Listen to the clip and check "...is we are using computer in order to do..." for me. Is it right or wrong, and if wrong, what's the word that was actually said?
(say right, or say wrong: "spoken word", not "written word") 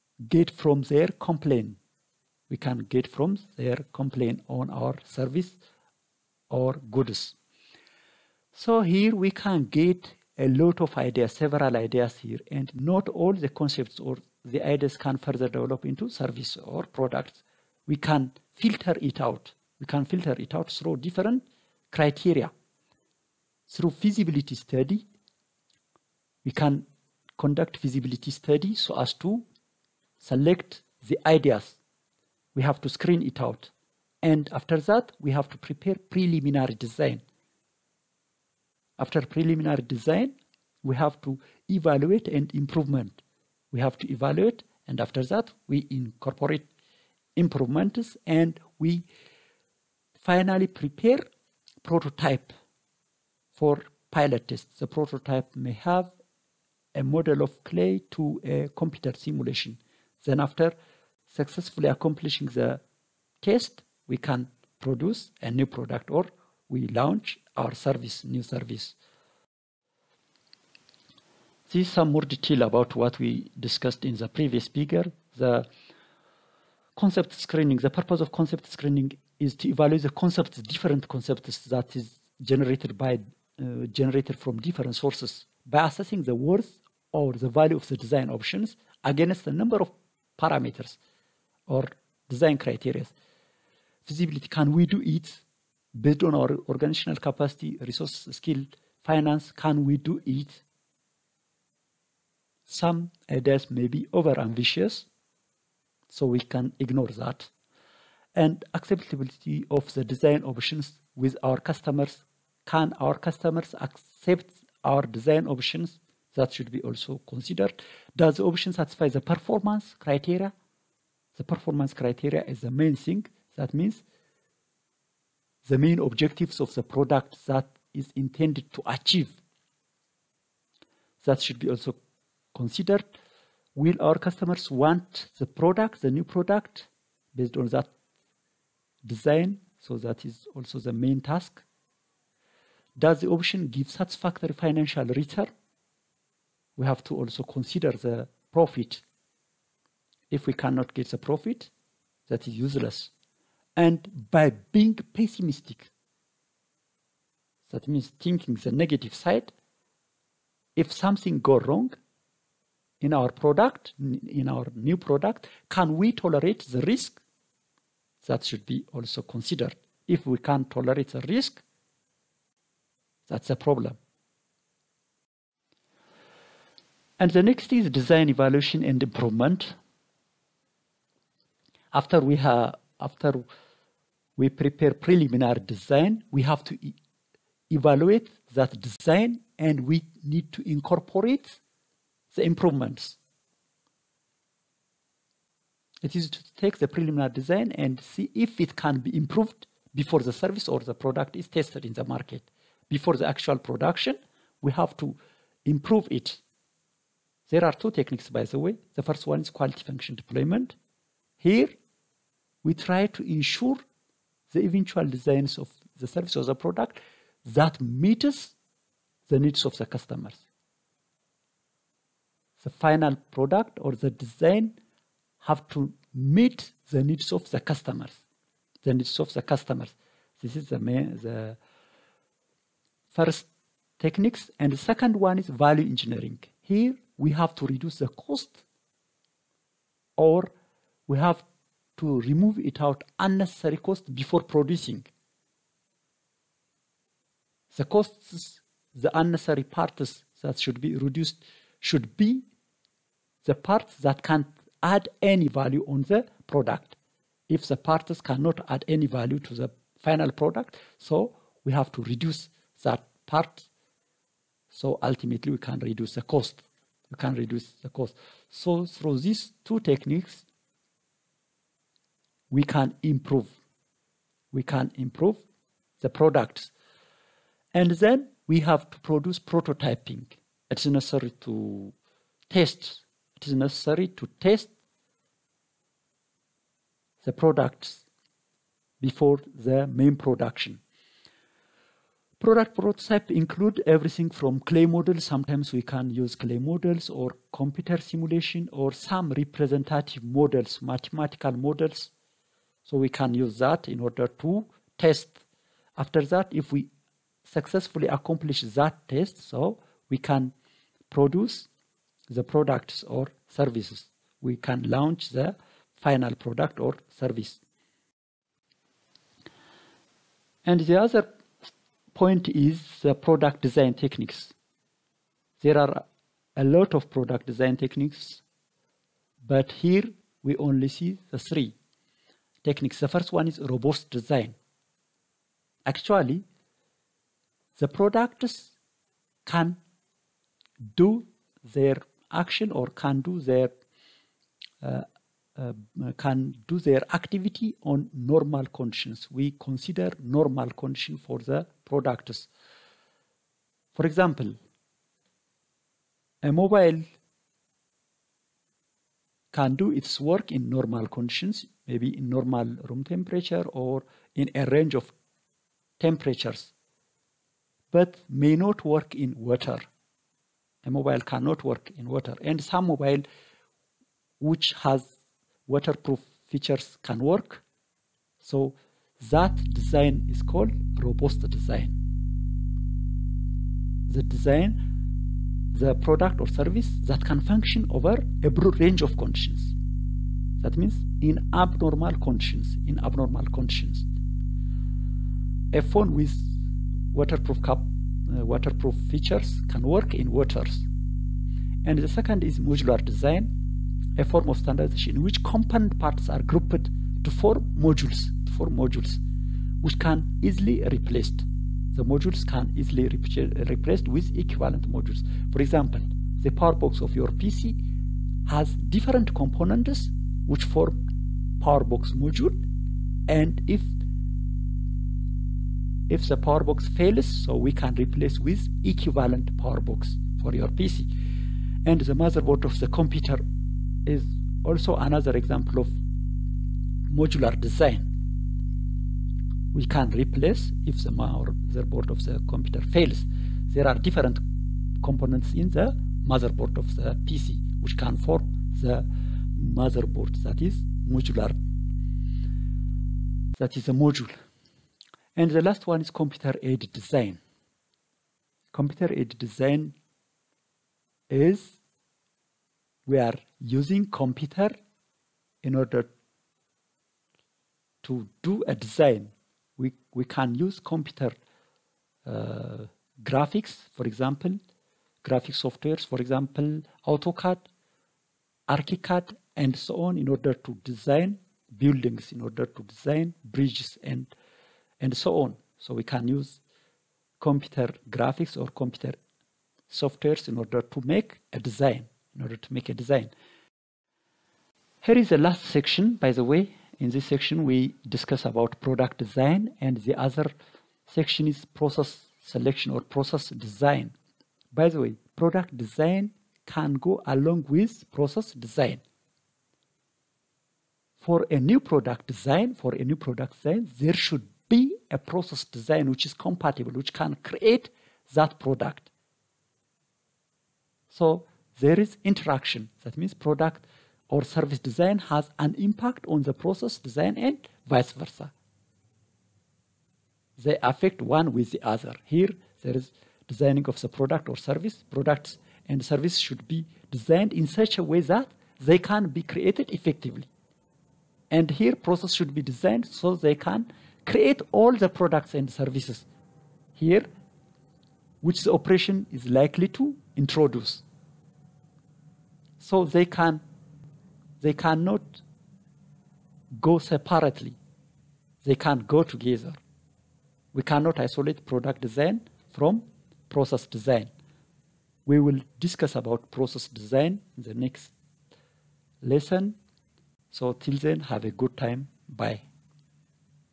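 right.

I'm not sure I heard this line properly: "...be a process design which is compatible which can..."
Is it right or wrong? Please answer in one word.
right.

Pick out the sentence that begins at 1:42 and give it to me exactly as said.
Some ideas may be over ambitious, so we can ignore that.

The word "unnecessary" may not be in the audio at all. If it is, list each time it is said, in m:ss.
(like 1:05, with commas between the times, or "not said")
4:03, 4:09.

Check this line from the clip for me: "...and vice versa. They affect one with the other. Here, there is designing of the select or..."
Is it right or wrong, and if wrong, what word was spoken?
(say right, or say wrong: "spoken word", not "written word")
wrong: "product", not "select".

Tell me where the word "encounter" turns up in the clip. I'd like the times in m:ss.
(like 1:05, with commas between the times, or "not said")
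not said.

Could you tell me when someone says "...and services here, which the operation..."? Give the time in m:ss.
9:05.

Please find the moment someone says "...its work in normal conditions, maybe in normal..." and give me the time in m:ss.
5:59.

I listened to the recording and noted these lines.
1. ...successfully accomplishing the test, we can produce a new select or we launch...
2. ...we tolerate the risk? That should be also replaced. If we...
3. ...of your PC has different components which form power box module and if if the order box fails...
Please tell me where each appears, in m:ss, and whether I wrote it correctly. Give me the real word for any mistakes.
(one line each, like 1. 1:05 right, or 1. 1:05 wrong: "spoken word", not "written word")
1. 1:01 wrong: "product", not "select"
2. 2:45 wrong: "considered", not "replaced"
3. 6:57 wrong: "power", not "order".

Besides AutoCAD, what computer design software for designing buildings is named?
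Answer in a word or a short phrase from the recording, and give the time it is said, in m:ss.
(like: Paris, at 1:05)
ArchiCAD, at 7:58.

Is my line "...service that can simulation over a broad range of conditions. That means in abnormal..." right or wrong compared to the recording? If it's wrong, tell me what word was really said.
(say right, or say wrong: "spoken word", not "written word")
wrong: "function", not "simulation".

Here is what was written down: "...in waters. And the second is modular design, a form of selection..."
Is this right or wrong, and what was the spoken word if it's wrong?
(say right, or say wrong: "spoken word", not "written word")
wrong: "standardization", not "selection".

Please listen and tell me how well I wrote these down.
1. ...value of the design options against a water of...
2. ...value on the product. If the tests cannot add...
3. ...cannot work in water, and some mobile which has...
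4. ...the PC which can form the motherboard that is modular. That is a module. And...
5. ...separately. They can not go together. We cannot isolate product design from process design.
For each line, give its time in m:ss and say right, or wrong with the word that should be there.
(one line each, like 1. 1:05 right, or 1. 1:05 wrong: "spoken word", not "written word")
1. 1:27 wrong: "number", not "water"
2. 4:15 wrong: "parts", not "tests"
3. 6:11 right
4. 7:26 right
5. 9:16 right.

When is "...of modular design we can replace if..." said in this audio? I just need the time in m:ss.
7:15.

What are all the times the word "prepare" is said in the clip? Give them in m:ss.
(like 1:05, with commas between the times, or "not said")
0:35, 0:50, 3:04.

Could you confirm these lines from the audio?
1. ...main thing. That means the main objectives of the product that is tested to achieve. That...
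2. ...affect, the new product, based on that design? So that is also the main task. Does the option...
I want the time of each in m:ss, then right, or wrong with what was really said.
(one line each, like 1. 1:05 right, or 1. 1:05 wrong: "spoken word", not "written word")
1. 2:02 wrong: "intended", not "tested"
2. 2:15 wrong: "product", not "affect".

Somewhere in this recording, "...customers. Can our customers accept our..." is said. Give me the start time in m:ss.
1:51.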